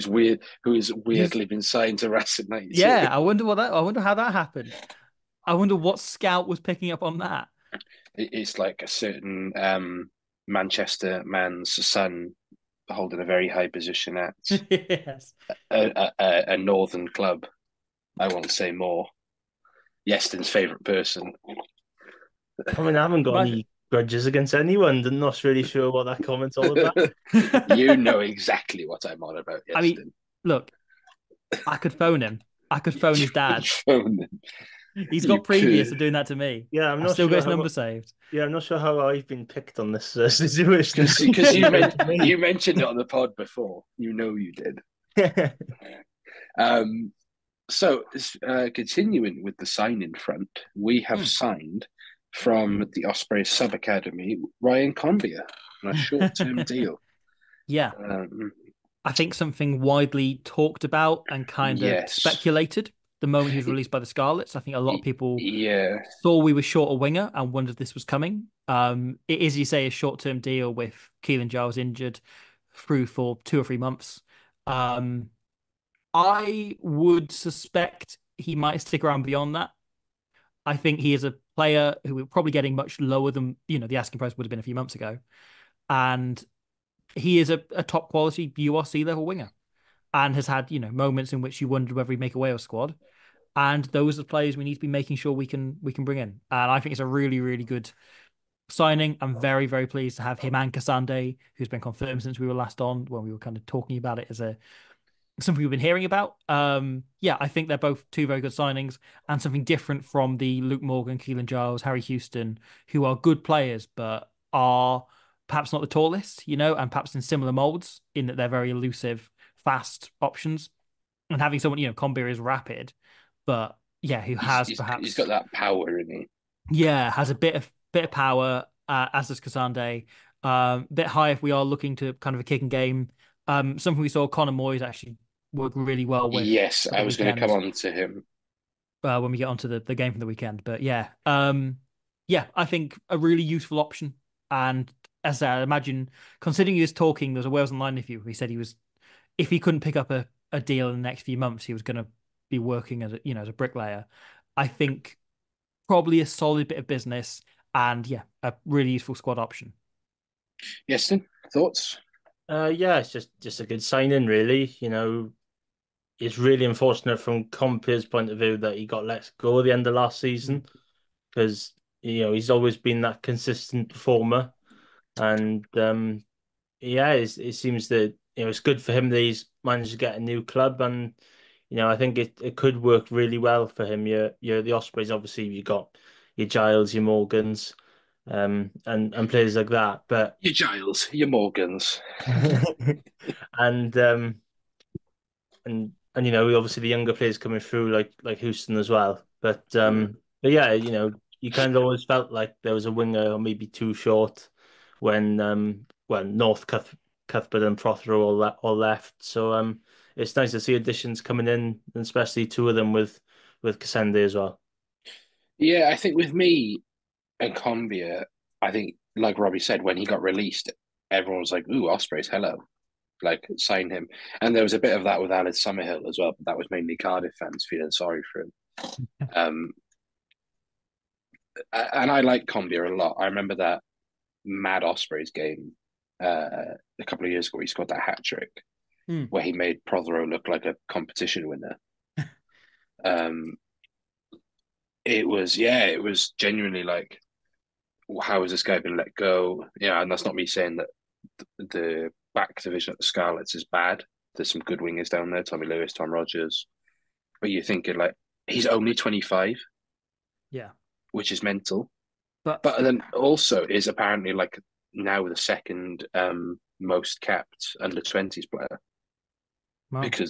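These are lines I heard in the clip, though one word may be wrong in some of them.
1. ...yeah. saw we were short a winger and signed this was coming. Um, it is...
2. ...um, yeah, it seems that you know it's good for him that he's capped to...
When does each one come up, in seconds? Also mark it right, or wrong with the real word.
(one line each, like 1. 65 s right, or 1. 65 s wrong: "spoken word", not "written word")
1. 65 s wrong: "wondered", not "signed"
2. 175 s wrong: "managed", not "capped".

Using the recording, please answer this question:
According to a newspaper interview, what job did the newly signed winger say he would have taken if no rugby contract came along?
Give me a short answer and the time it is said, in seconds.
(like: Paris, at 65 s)
Bricklayer, at 153 s.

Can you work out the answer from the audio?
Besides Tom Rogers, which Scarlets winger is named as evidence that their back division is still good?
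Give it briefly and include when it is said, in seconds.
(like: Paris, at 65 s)
Tommy Lewis, at 255 s.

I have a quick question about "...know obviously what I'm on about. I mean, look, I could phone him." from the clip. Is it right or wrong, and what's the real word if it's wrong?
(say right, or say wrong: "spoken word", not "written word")
wrong: "exactly", not "obviously".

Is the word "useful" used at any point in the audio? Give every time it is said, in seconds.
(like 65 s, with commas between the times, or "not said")
143 s, 158 s.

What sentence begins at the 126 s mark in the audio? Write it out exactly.
Yeah, has a bit of bit of power, uh, as does Kasende.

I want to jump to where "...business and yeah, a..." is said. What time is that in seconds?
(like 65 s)
156 s.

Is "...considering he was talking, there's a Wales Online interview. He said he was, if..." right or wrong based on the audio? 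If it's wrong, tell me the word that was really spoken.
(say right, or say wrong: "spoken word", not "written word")
right.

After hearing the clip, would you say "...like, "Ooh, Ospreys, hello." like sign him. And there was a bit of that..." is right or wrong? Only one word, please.
right.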